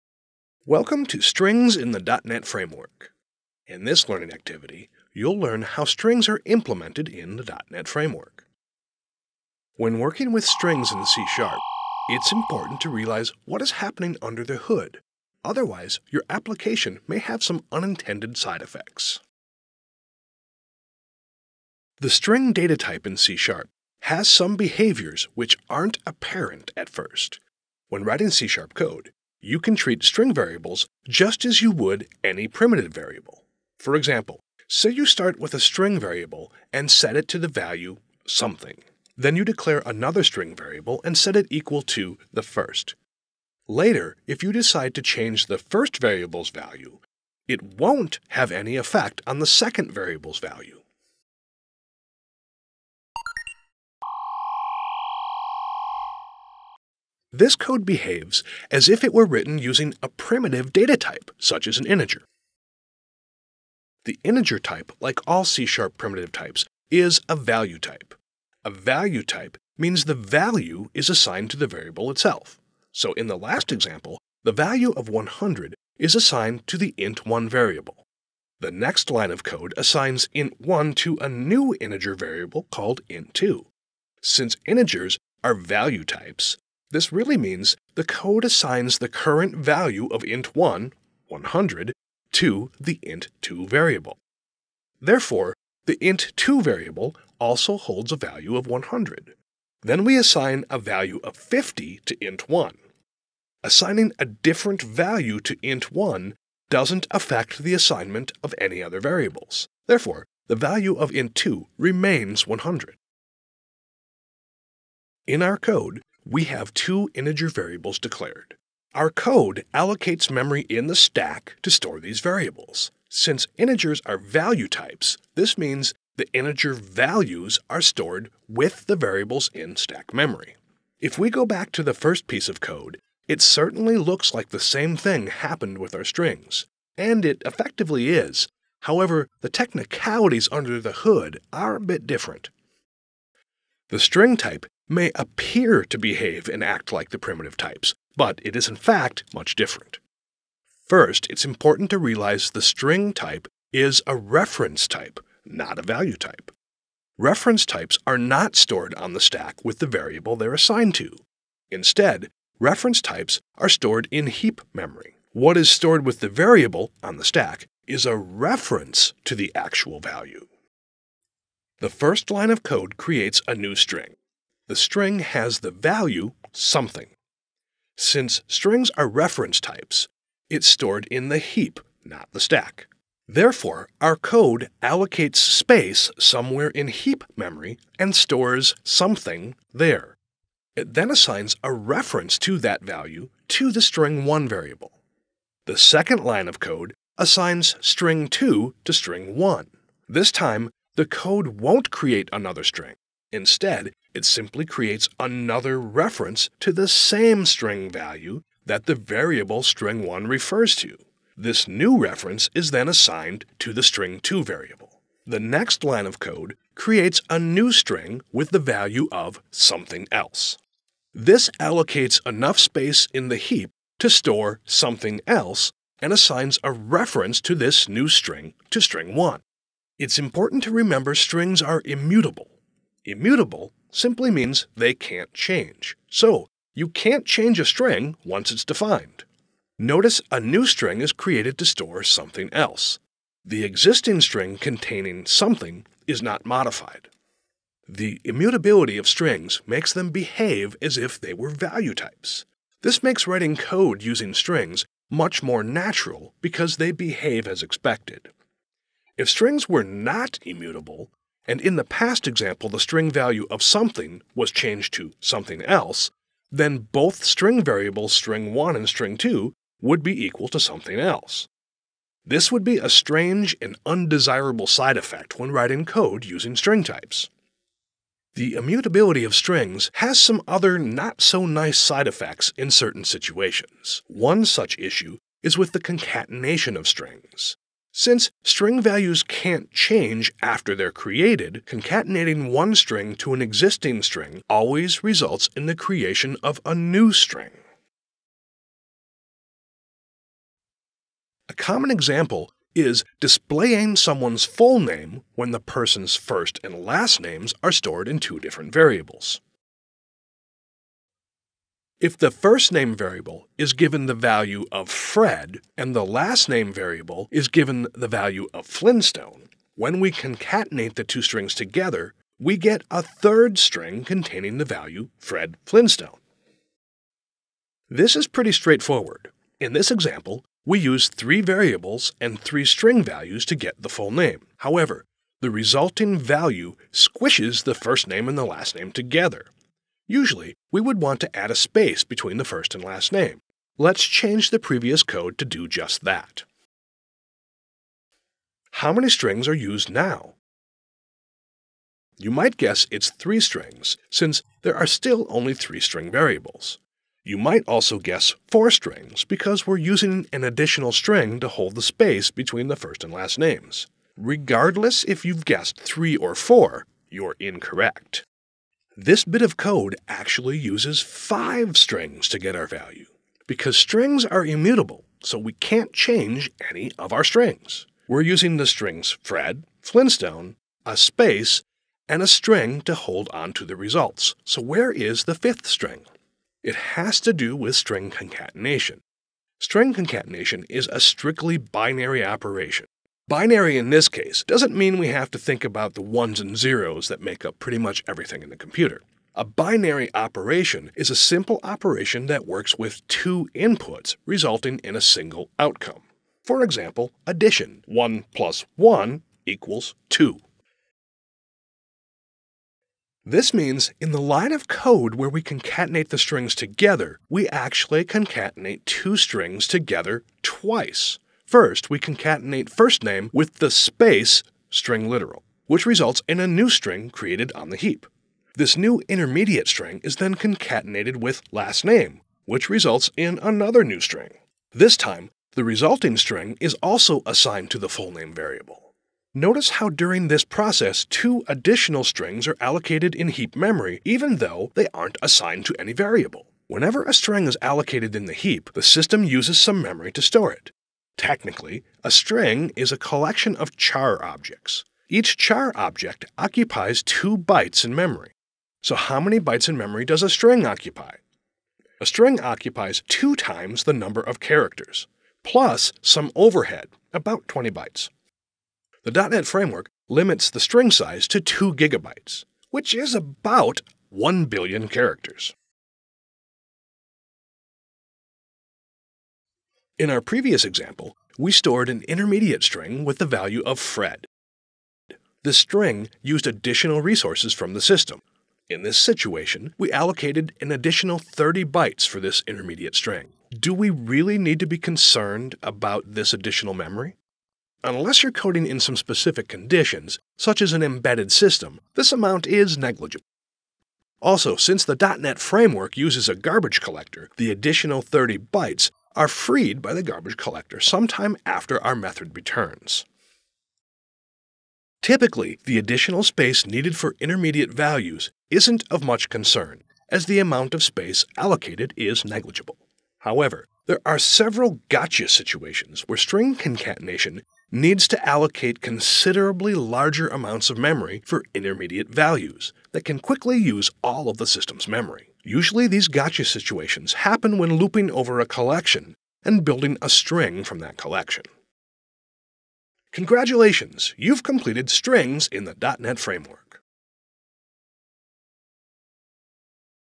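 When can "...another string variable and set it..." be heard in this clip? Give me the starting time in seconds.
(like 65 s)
39 s.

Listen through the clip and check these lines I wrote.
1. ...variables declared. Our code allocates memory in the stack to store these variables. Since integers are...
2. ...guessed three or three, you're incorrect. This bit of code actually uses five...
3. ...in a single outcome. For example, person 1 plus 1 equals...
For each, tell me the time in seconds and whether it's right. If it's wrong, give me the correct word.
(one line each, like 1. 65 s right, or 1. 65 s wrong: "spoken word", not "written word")
1. 117 s right
2. 365 s wrong: "four", not "three"
3. 404 s wrong: "addition", not "person".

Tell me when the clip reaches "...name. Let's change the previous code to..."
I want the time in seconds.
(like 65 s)
343 s.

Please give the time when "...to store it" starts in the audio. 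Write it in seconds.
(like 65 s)
450 s.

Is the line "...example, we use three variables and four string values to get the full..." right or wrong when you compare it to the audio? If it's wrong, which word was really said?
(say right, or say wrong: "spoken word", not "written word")
wrong: "three", not "four".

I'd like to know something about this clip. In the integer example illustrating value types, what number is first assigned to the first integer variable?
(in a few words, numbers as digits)
100.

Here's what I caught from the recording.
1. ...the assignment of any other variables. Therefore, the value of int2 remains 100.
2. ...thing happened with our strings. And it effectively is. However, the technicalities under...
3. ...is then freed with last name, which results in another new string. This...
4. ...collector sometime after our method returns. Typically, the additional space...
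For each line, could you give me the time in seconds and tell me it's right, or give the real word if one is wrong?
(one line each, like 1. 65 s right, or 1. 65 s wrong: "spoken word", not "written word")
1. 107 s right
2. 134 s right
3. 430 s wrong: "concatenated", not "freed"
4. 510 s right.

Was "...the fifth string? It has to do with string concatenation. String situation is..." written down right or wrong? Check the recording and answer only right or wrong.
wrong.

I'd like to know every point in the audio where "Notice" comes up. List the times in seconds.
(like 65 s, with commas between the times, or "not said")
239 s, 439 s.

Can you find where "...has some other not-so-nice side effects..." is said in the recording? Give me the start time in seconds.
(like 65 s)
279 s.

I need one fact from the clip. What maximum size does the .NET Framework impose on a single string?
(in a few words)
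2 gigabytes.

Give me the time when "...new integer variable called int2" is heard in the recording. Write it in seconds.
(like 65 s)
81 s.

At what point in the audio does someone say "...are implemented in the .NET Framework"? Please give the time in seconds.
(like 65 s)
6 s.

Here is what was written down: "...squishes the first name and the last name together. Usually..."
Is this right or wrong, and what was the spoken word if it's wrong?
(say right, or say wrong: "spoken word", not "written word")
right.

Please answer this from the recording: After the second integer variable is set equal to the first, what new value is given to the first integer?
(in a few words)
50.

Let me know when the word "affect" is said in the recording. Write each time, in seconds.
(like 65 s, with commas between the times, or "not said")
107 s.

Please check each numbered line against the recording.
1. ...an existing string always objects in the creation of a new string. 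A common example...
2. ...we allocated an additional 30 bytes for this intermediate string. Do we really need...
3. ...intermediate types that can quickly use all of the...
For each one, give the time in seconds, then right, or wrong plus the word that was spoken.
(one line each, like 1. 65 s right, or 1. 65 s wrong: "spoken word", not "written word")
1. 293 s wrong: "results", not "objects"
2. 489 s right
3. 531 s wrong: "values", not "types".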